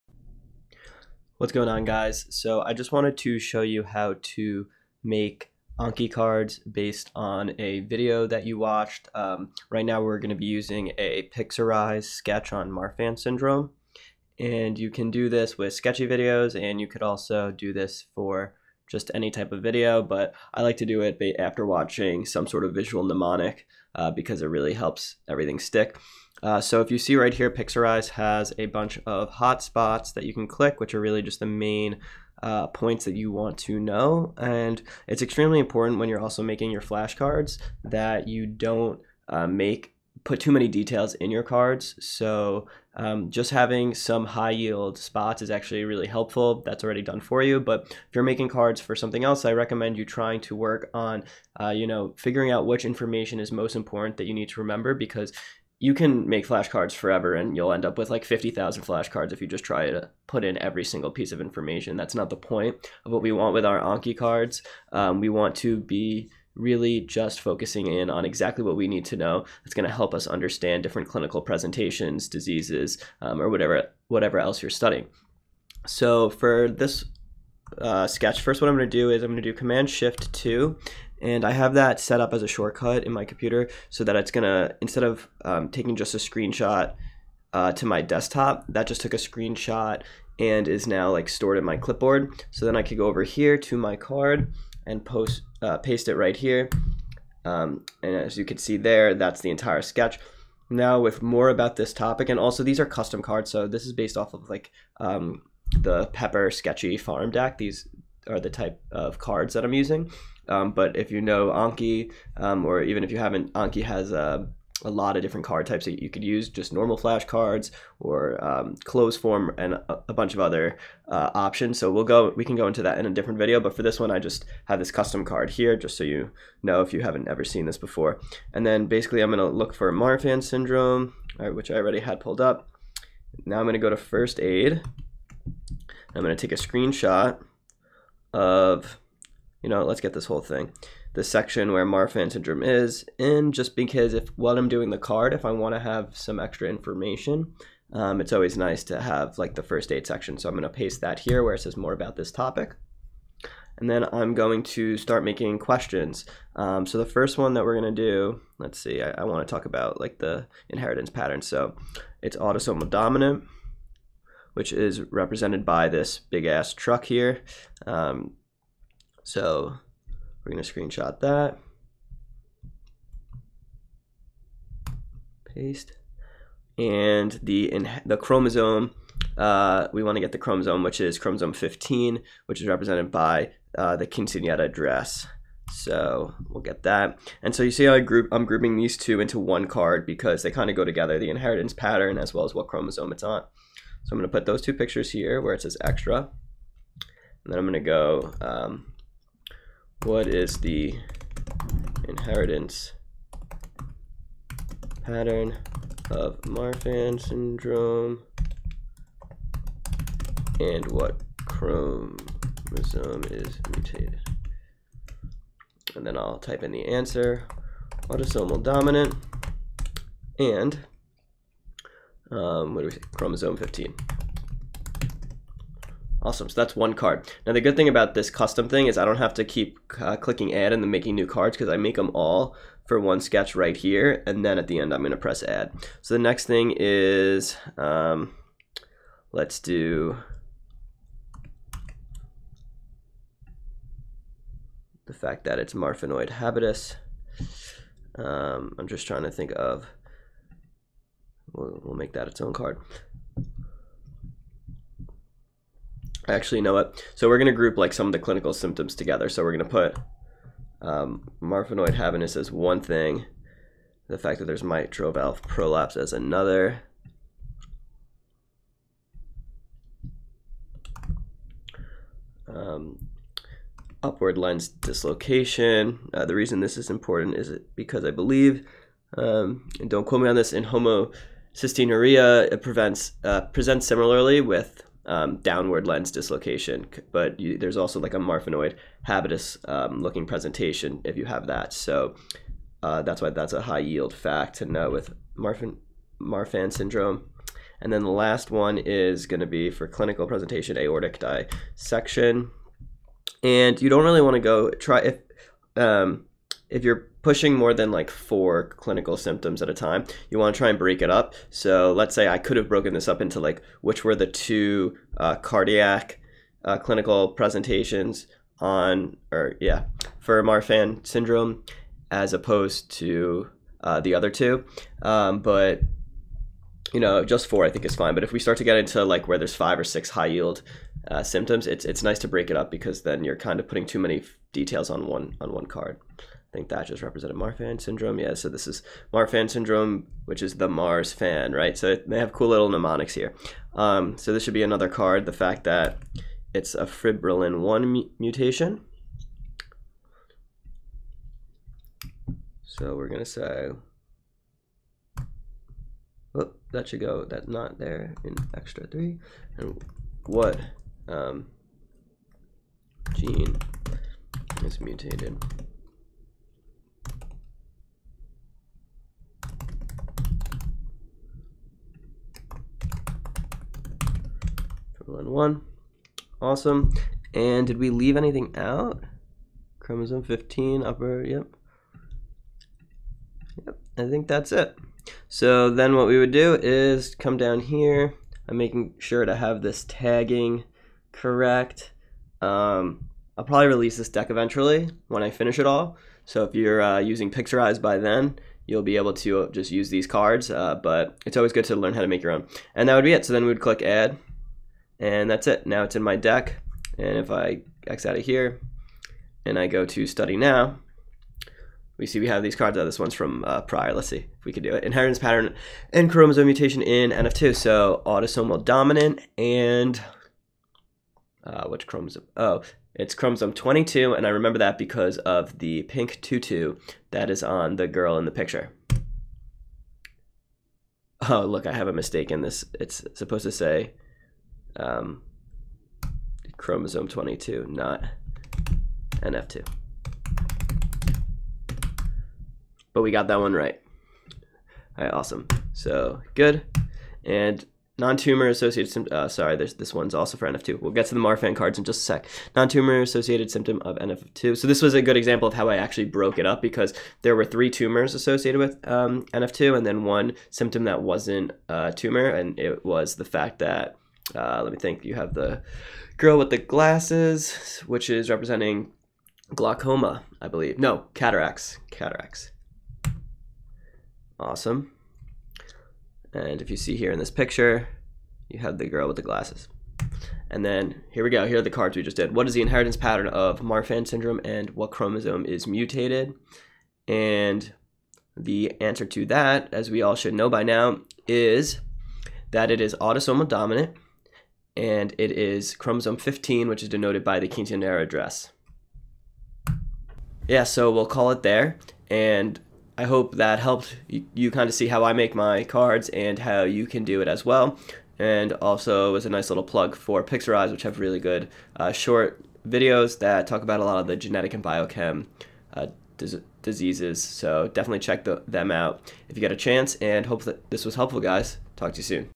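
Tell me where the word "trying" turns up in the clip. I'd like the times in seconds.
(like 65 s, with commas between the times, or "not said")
50 s, 249 s.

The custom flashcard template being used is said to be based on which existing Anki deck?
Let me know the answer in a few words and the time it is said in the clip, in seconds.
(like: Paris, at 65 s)
Pepper Sketchy Pharm deck, at 106 s.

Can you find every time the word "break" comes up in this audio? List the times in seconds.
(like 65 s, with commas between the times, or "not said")
310 s, 332 s.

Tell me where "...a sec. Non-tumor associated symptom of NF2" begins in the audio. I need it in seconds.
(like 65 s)
452 s.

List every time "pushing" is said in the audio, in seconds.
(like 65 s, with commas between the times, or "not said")
307 s.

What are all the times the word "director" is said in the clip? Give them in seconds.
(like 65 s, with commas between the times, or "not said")
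not said.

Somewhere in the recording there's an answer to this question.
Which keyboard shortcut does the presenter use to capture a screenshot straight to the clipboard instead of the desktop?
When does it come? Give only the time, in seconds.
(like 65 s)
79 s.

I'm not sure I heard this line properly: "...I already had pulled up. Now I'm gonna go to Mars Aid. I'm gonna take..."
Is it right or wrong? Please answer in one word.
wrong.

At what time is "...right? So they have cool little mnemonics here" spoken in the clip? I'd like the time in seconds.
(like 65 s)
341 s.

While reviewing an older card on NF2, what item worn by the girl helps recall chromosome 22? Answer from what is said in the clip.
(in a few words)
pink tutu.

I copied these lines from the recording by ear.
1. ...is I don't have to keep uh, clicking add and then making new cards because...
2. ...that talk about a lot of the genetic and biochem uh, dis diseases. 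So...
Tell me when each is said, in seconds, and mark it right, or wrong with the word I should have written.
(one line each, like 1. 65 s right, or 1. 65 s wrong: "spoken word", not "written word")
1. 228 s right
2. 513 s right.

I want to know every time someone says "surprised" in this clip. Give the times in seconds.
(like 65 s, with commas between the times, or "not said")
not said.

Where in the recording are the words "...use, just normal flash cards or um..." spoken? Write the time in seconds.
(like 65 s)
116 s.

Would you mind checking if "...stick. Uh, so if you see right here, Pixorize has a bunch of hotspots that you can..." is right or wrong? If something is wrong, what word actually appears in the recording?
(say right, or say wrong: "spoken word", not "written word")
right.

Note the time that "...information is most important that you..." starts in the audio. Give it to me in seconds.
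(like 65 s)
52 s.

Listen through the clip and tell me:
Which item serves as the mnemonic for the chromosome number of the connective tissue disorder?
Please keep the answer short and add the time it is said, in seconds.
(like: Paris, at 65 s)
quinceanera dress, at 184 s.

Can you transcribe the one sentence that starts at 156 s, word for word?
Um, so the first one that we're going to do, let's see, I, I want to talk about like the inheritance pattern.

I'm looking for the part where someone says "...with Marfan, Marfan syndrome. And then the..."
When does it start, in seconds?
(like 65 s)
294 s.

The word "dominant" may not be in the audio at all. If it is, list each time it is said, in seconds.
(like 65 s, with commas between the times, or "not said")
162 s, 218 s, 418 s, 493 s.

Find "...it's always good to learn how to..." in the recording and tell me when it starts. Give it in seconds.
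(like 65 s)
401 s.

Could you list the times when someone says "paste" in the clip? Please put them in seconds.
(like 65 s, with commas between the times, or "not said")
95 s, 150 s, 175 s.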